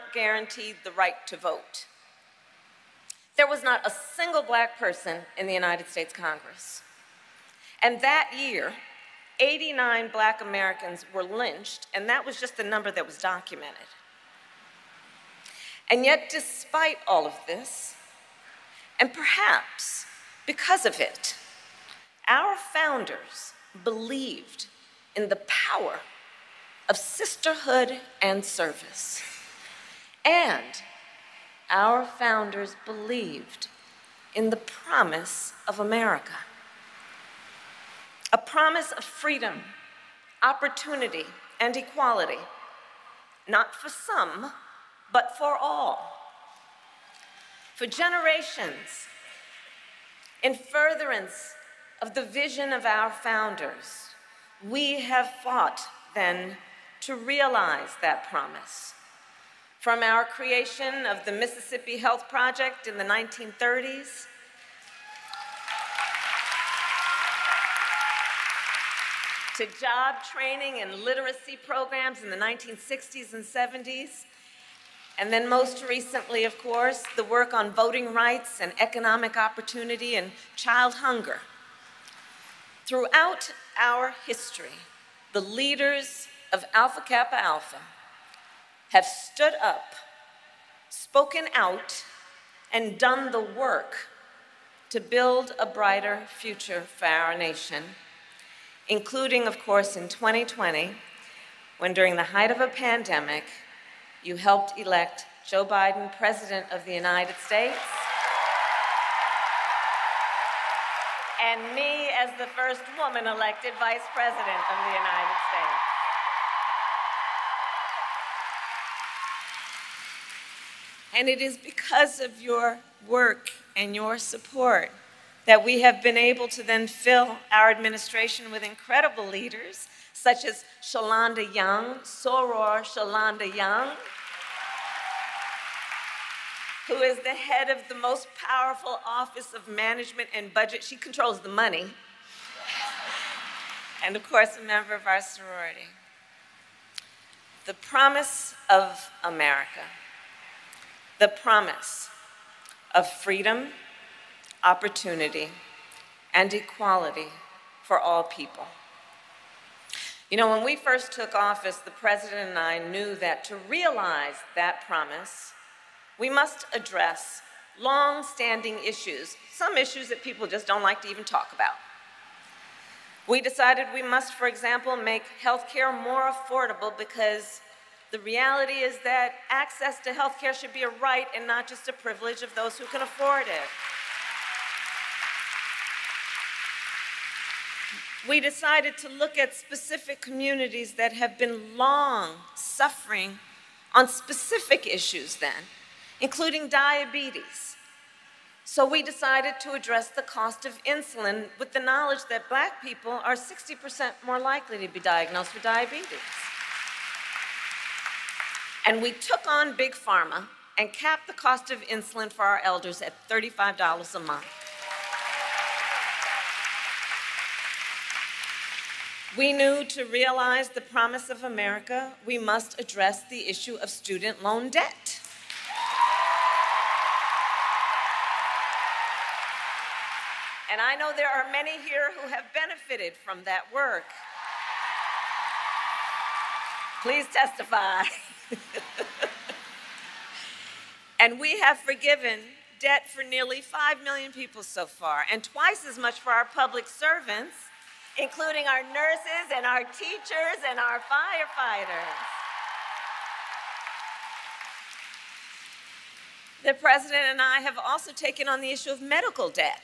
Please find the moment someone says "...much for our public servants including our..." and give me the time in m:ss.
4:05.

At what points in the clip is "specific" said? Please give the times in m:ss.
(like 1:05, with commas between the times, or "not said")
3:09, 3:14.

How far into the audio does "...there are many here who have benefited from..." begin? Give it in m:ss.
3:51.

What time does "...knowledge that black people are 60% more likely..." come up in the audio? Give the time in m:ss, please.
3:21.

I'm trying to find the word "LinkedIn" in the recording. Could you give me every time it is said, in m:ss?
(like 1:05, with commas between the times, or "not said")
not said.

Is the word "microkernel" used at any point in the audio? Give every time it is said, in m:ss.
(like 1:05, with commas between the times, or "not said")
not said.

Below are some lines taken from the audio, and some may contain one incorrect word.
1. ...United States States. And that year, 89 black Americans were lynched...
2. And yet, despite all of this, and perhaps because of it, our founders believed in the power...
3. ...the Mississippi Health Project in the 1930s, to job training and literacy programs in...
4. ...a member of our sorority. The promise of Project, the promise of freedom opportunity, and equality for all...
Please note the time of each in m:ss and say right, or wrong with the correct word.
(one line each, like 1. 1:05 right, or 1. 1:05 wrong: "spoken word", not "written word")
1. 0:05 wrong: "Congress", not "States"
2. 0:15 right
3. 1:01 right
4. 2:24 wrong: "America", not "Project".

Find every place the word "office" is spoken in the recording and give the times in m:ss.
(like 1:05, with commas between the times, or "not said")
2:19, 2:41.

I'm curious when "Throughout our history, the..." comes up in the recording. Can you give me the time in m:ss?
1:22.